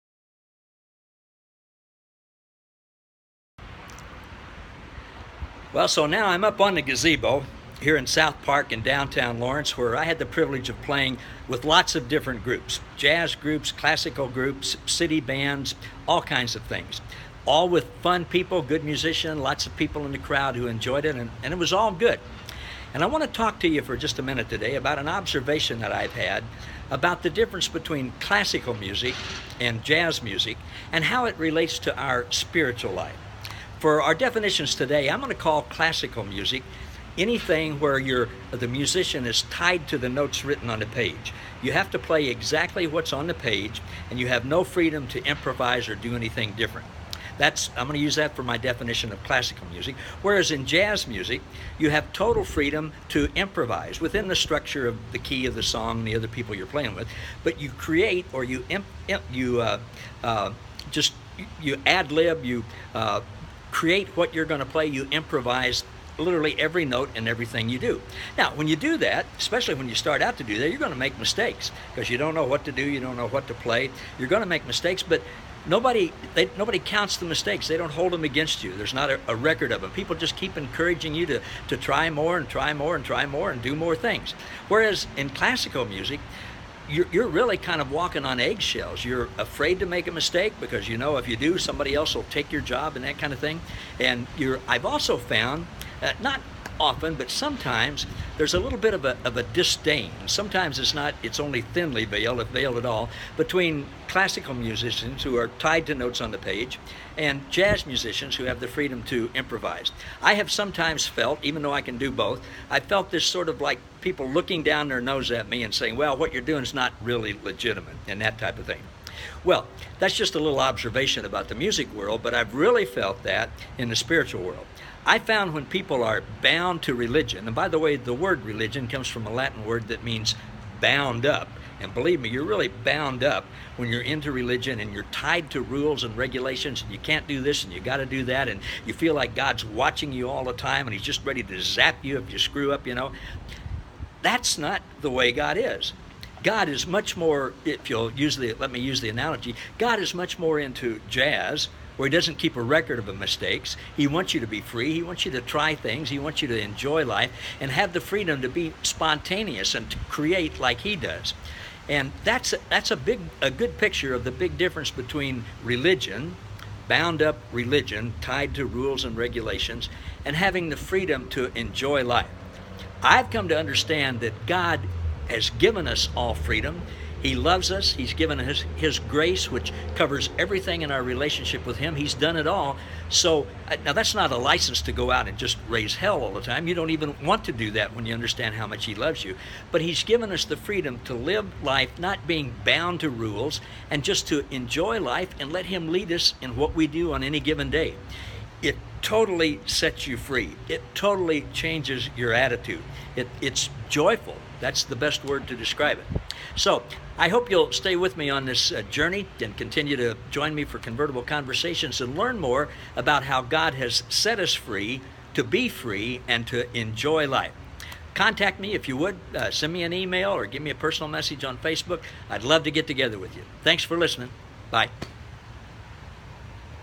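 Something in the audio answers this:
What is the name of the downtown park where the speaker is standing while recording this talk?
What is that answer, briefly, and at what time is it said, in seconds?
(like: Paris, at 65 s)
South Park, at 8 s.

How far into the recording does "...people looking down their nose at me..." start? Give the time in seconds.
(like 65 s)
114 s.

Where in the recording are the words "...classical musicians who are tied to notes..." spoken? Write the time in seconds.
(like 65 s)
104 s.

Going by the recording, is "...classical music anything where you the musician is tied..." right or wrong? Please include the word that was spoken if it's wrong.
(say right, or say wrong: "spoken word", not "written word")
right.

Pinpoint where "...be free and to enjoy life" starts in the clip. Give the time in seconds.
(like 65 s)
215 s.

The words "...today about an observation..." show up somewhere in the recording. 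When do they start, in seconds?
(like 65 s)
24 s.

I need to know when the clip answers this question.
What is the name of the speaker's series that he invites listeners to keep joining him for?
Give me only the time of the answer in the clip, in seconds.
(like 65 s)
210 s.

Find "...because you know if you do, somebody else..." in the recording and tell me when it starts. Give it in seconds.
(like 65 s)
90 s.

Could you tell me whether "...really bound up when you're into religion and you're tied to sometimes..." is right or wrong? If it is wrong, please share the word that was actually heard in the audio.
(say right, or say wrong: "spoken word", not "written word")
wrong: "rules", not "sometimes".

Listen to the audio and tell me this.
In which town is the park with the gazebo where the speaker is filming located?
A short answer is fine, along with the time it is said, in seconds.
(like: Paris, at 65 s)
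Lawrence, at 9 s.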